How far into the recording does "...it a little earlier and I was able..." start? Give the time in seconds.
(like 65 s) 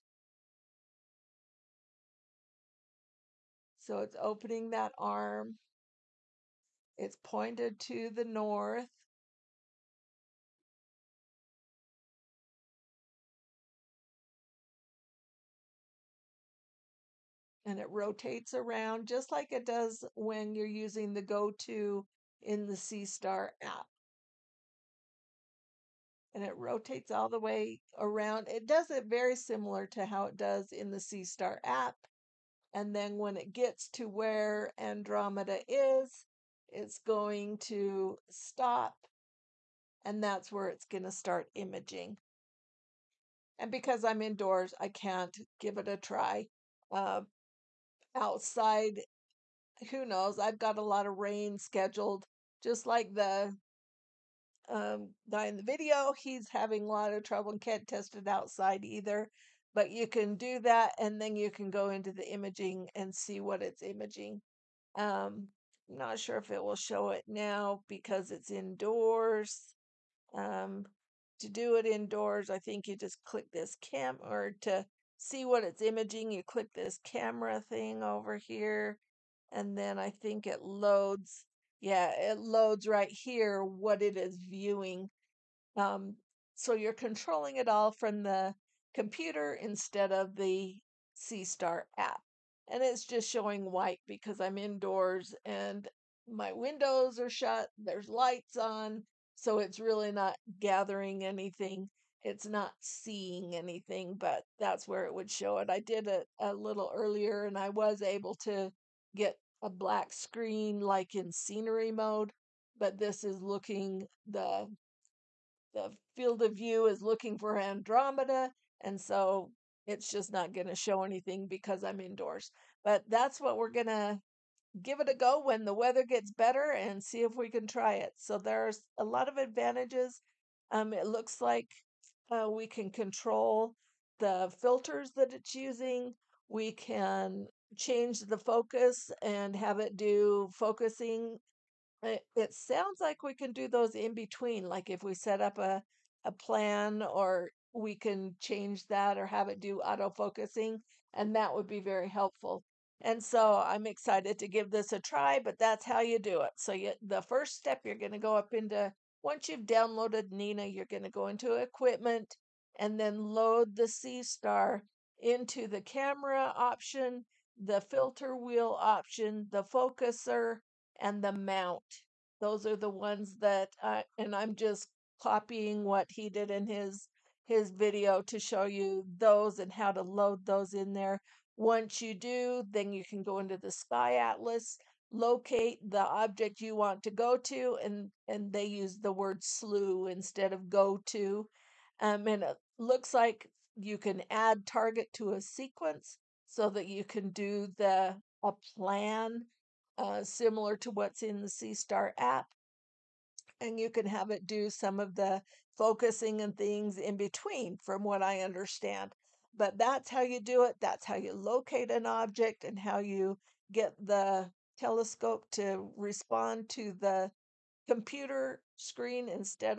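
106 s.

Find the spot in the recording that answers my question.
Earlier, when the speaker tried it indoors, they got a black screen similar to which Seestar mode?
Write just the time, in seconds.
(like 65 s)
111 s.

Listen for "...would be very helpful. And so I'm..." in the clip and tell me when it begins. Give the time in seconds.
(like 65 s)
151 s.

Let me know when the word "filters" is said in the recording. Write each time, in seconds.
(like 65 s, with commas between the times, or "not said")
134 s, 167 s.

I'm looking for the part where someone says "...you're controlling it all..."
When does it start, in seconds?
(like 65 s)
86 s.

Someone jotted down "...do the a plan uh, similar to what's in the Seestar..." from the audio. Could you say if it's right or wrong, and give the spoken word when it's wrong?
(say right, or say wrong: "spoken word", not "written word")
right.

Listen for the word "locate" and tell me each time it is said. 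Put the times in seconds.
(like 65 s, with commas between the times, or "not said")
185 s, 211 s.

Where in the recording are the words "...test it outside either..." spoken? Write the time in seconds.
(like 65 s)
57 s.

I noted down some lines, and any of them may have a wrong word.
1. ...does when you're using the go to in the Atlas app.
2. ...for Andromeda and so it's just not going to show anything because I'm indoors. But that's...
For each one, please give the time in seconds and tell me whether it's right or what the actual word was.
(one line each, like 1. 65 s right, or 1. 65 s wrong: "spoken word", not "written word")
1. 19 s wrong: "Seestar", not "Atlas"
2. 117 s right.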